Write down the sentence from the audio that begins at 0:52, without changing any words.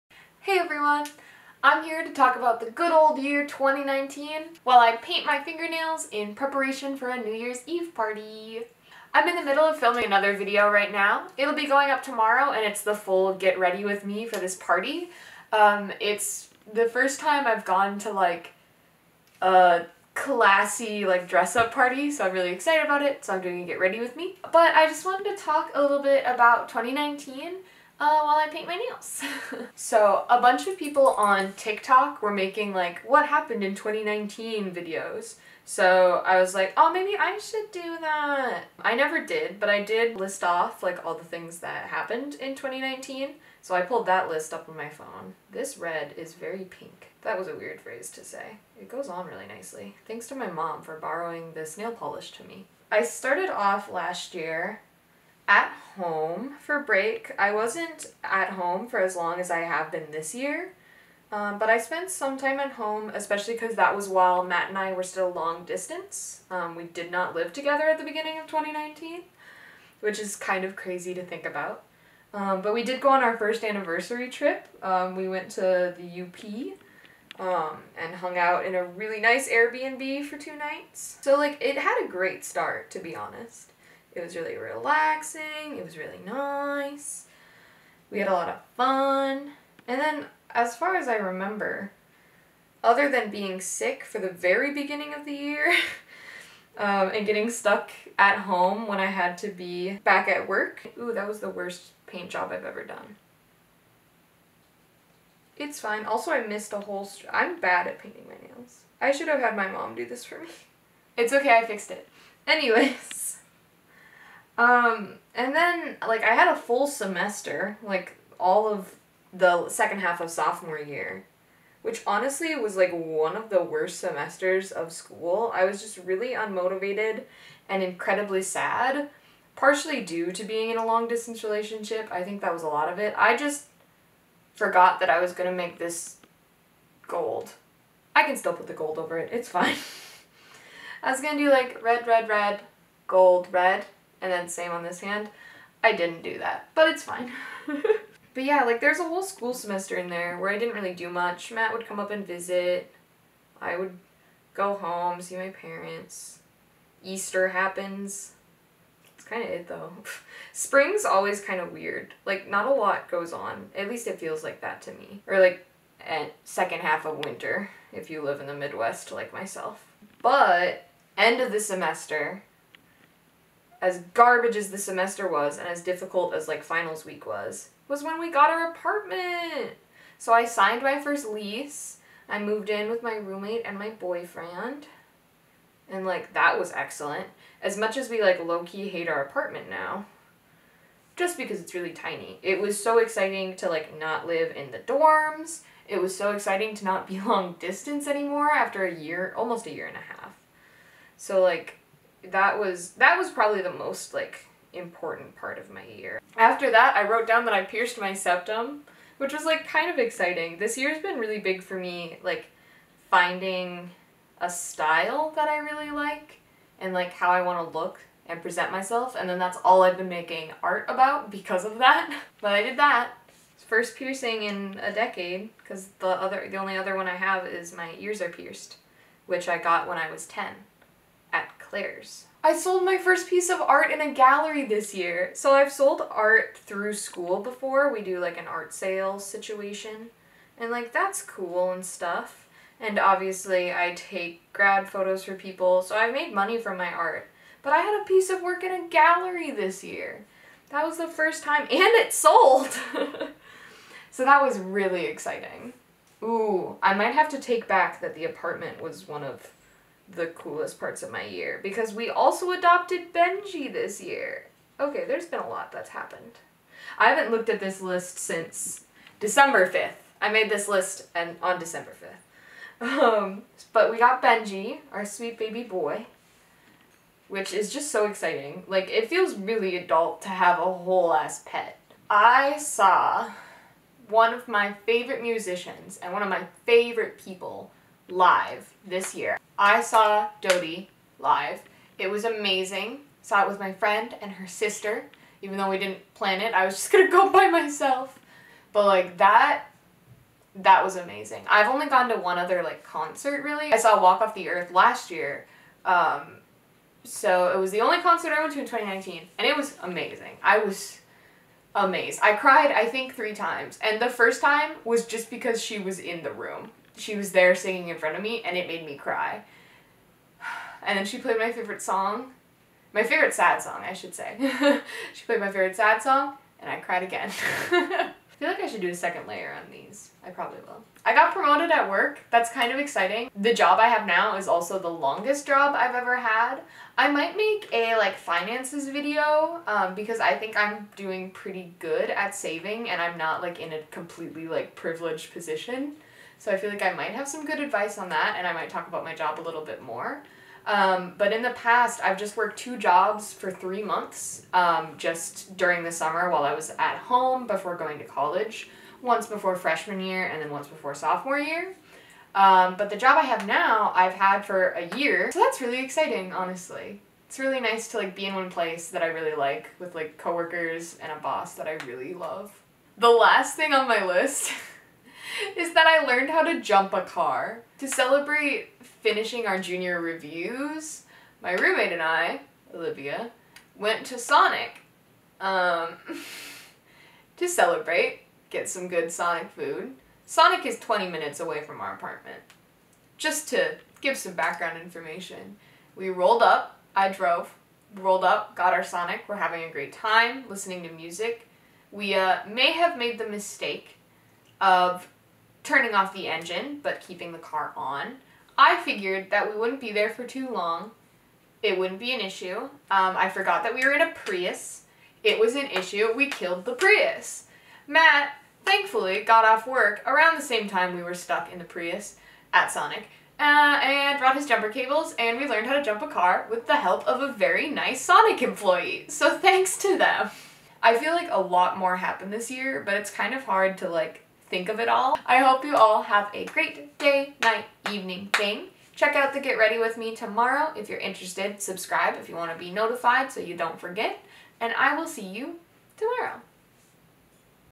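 I started off last year at home for break.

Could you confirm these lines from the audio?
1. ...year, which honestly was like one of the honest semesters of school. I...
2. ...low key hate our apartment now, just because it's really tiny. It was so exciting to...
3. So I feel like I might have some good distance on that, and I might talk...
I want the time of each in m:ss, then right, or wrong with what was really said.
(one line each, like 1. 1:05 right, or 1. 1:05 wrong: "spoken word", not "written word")
1. 2:00 wrong: "worst", not "honest"
2. 3:08 right
3. 5:46 wrong: "advice", not "distance".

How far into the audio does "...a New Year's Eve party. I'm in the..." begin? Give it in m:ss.
0:07.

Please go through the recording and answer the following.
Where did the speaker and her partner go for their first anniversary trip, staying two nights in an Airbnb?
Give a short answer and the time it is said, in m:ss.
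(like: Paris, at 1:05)
The UP, at 1:15.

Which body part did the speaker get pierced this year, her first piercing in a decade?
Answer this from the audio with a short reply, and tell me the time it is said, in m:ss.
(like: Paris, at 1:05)
Septum, at 3:28.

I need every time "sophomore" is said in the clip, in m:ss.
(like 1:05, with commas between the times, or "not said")
2:00, 6:00.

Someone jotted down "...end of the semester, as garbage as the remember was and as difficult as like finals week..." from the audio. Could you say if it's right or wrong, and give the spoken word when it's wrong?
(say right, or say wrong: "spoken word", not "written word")
wrong: "semester", not "remember".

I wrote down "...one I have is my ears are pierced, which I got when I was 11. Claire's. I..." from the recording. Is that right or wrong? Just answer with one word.
wrong.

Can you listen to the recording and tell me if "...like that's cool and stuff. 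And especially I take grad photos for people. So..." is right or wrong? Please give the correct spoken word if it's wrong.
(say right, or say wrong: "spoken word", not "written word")
wrong: "obviously", not "especially".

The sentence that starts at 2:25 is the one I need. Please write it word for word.
I didn't do that, but it's fine.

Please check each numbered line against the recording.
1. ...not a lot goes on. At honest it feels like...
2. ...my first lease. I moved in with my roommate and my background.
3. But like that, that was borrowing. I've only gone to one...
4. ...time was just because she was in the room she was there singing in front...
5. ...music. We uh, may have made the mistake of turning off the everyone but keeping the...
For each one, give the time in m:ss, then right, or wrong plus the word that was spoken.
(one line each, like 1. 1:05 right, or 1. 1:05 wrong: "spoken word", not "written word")
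1. 2:42 wrong: "least", not "honest"
2. 3:00 wrong: "boyfriend", not "background"
3. 4:58 wrong: "amazing", not "borrowing"
4. 5:14 right
5. 6:40 wrong: "engine", not "everyone".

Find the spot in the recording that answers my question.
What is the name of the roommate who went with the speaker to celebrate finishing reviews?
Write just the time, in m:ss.
6:22.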